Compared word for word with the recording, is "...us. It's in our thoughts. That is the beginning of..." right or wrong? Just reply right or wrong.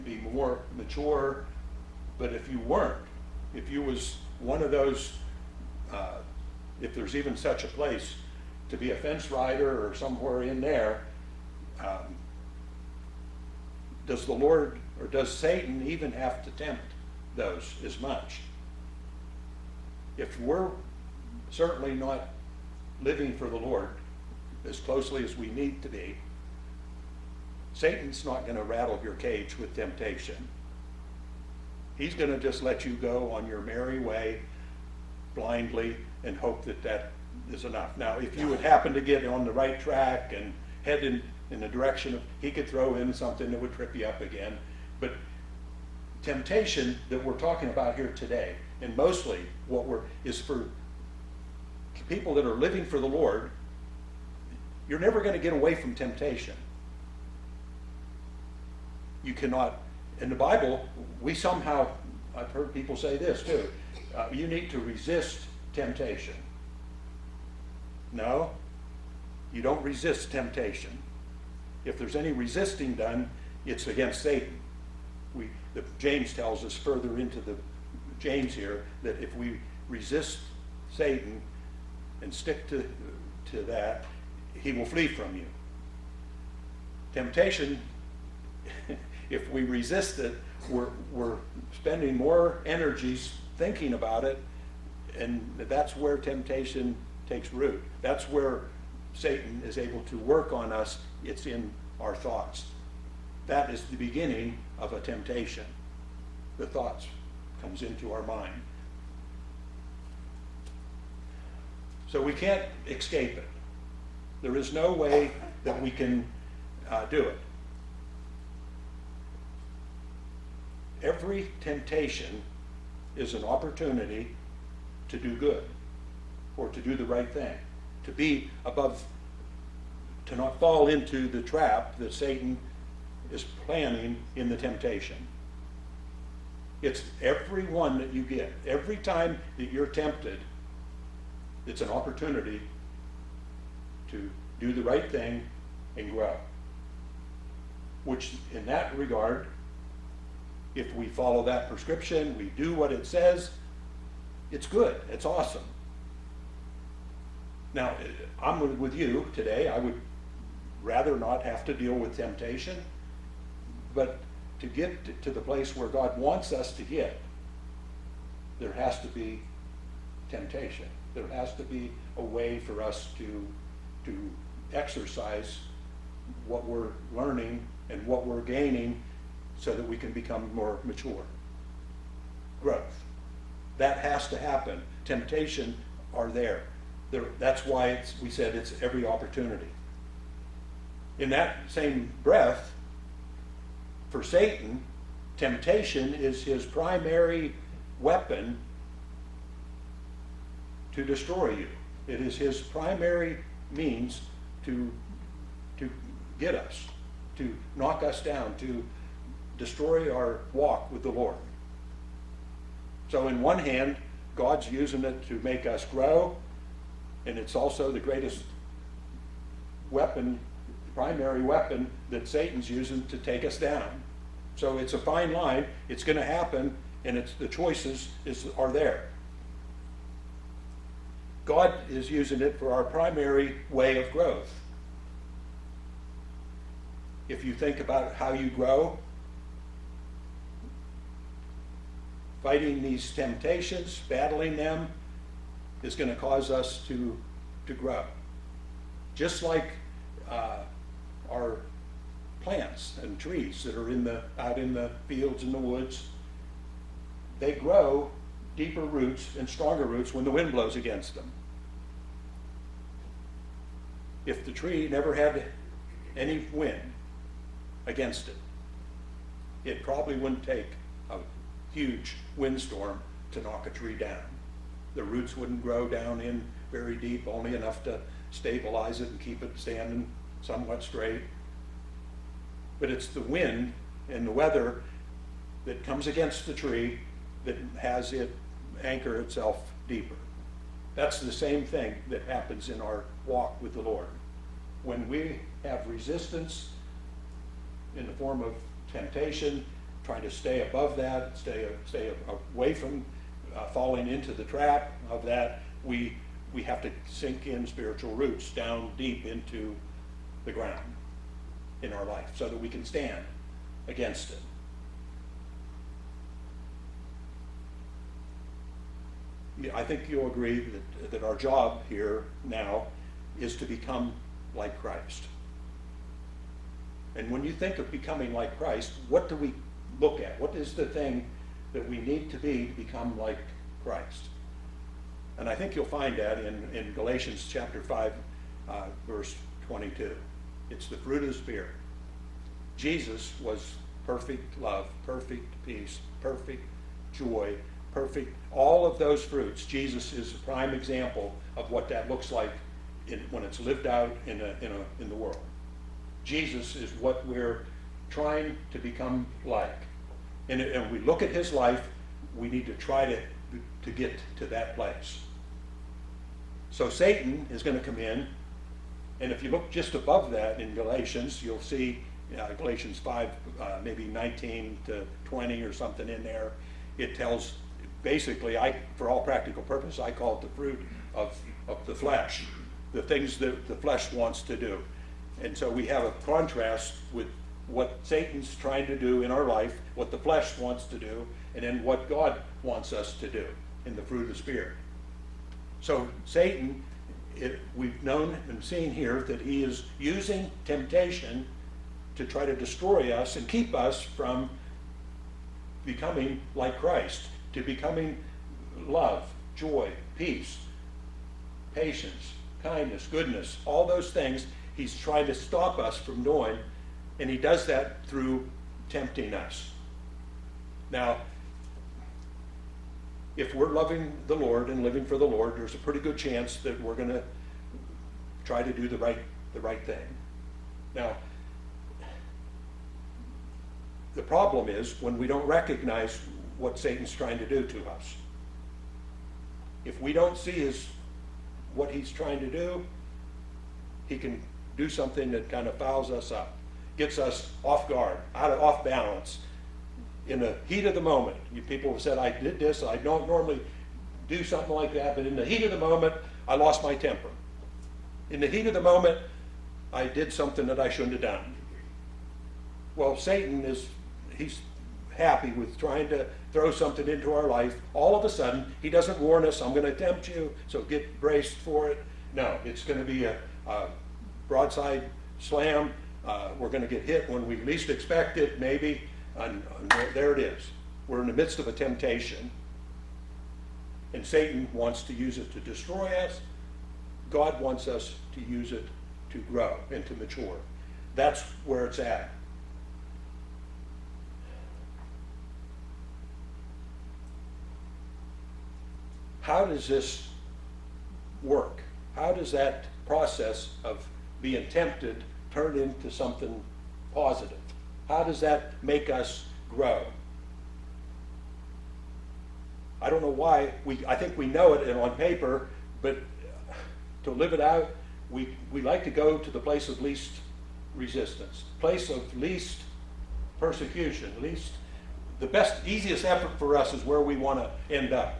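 right.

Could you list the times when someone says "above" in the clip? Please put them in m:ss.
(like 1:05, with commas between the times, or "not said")
2:08, 5:00, 6:09.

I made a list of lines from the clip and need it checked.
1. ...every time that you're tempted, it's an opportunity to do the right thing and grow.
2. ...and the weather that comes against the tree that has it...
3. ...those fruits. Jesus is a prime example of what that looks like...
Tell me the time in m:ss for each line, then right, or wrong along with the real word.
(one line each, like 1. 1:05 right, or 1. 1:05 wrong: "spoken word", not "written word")
1. 2:18 right
2. 4:44 right
3. 5:48 right.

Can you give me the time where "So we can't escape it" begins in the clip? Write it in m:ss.
1:52.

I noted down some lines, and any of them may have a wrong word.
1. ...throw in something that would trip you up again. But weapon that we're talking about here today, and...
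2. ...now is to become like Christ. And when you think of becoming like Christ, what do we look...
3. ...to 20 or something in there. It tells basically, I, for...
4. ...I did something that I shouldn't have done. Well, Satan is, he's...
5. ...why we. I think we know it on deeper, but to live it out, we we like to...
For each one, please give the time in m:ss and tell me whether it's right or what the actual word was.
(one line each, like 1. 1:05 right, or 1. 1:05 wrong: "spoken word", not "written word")
1. 0:42 wrong: "temptation", not "weapon"
2. 5:22 right
3. 6:14 right
4. 7:39 right
5. 8:33 wrong: "paper", not "deeper".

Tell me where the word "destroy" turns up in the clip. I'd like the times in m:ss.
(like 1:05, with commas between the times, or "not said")
3:21, 3:29, 6:42, 8:05.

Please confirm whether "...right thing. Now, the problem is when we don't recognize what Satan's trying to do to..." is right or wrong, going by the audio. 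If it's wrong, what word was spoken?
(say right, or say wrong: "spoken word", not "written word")
right.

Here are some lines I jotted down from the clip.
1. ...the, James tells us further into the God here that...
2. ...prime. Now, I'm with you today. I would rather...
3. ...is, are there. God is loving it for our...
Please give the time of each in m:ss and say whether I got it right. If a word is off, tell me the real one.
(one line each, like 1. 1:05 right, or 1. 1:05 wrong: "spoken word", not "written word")
1. 1:15 wrong: "James", not "God"
2. 2:35 wrong: "awesome", not "prime"
3. 3:48 wrong: "using", not "loving".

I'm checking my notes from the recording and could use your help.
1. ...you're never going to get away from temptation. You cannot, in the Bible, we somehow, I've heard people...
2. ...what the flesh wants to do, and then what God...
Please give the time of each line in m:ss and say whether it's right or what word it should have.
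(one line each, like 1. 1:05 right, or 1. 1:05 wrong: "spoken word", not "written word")
1. 0:54 right
2. 6:29 right.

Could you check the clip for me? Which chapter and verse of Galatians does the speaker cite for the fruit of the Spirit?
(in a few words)
Chapter 5, verse 22.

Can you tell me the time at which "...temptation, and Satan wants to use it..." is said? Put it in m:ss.
8:01.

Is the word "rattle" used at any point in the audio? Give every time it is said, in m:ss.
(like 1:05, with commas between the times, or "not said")
0:28.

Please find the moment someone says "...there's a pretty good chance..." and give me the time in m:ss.
7:05.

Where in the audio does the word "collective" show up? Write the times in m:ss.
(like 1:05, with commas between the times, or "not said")
not said.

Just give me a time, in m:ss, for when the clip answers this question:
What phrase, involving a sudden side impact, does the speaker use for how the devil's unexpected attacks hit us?
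7:54.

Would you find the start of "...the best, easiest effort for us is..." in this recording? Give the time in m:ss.
8:45.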